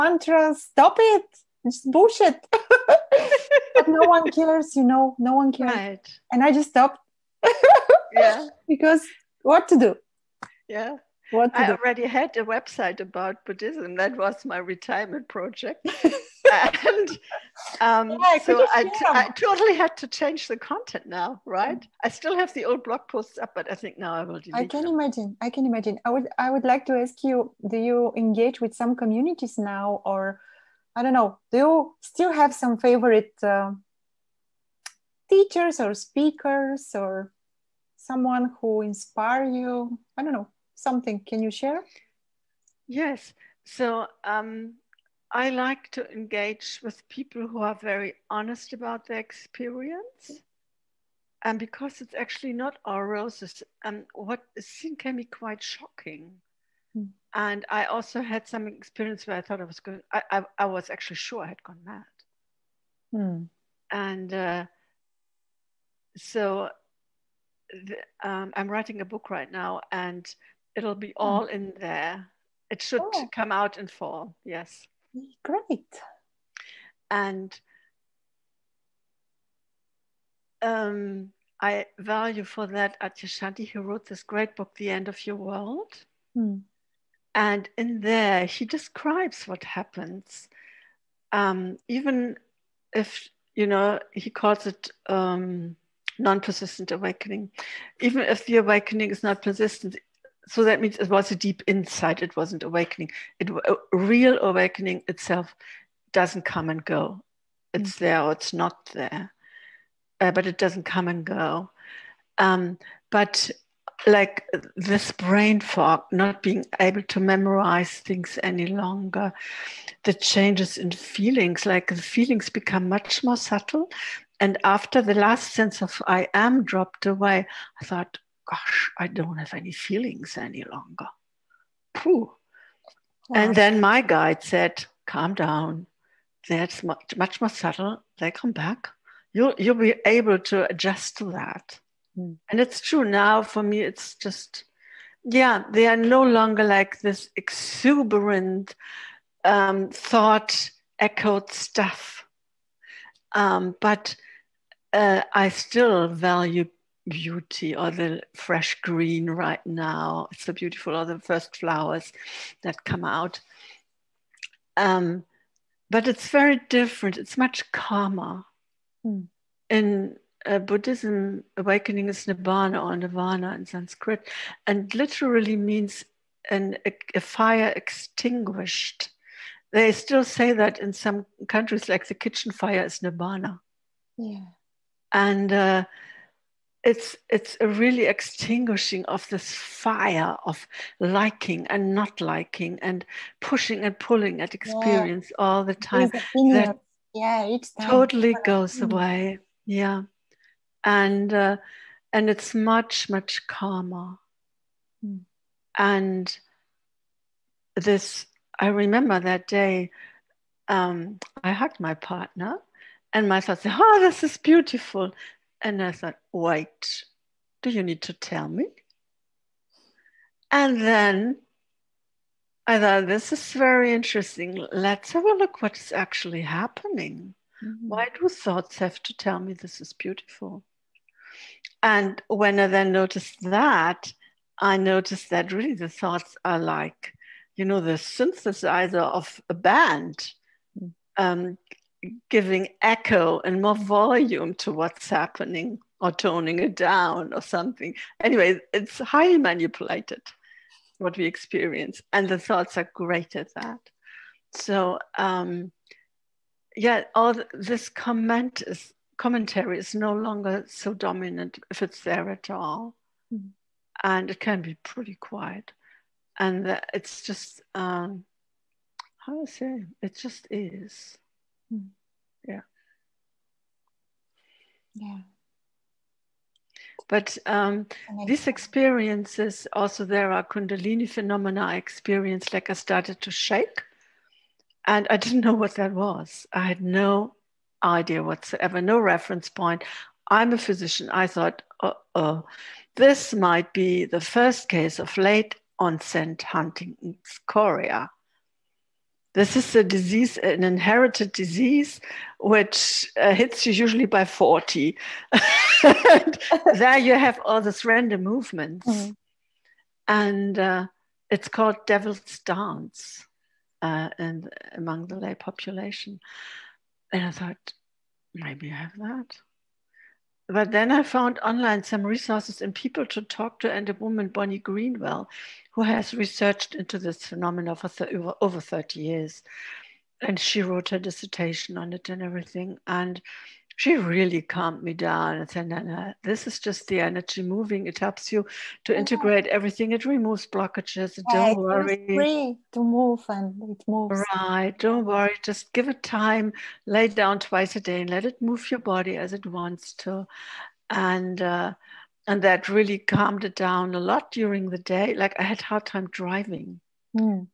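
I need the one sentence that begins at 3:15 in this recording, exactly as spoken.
all the time that yeah it totally goes away yeah and uh, and it's much much calmer mm.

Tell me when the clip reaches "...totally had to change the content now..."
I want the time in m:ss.
0:19.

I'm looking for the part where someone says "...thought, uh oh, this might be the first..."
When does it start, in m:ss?
4:51.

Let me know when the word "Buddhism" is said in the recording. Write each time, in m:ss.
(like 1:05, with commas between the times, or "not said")
0:13, 2:50.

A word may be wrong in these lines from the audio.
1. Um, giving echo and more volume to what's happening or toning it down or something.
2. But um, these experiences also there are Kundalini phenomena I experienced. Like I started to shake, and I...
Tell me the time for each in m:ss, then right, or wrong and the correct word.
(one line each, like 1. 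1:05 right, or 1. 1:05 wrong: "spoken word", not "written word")
1. 4:01 right
2. 4:37 right.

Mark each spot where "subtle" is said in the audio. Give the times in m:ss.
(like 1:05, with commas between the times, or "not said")
2:03, 2:17.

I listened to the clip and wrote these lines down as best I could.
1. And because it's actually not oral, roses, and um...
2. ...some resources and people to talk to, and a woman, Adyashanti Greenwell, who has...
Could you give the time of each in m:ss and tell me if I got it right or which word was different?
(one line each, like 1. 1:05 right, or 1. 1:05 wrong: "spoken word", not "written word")
1. 0:51 right
2. 5:21 wrong: "Bonnie", not "Adyashanti".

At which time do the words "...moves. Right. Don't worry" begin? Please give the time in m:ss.
5:43.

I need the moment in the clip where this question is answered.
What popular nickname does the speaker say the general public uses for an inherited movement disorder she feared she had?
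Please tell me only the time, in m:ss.
5:11.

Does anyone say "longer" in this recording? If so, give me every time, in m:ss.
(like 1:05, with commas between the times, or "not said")
1:58, 2:10, 2:26, 4:20.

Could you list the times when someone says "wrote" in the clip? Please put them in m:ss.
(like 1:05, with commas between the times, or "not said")
1:23, 5:30.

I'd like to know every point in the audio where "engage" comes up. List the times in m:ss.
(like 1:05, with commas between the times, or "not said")
0:28, 0:46.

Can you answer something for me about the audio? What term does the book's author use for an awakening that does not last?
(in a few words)
non persistent awakening.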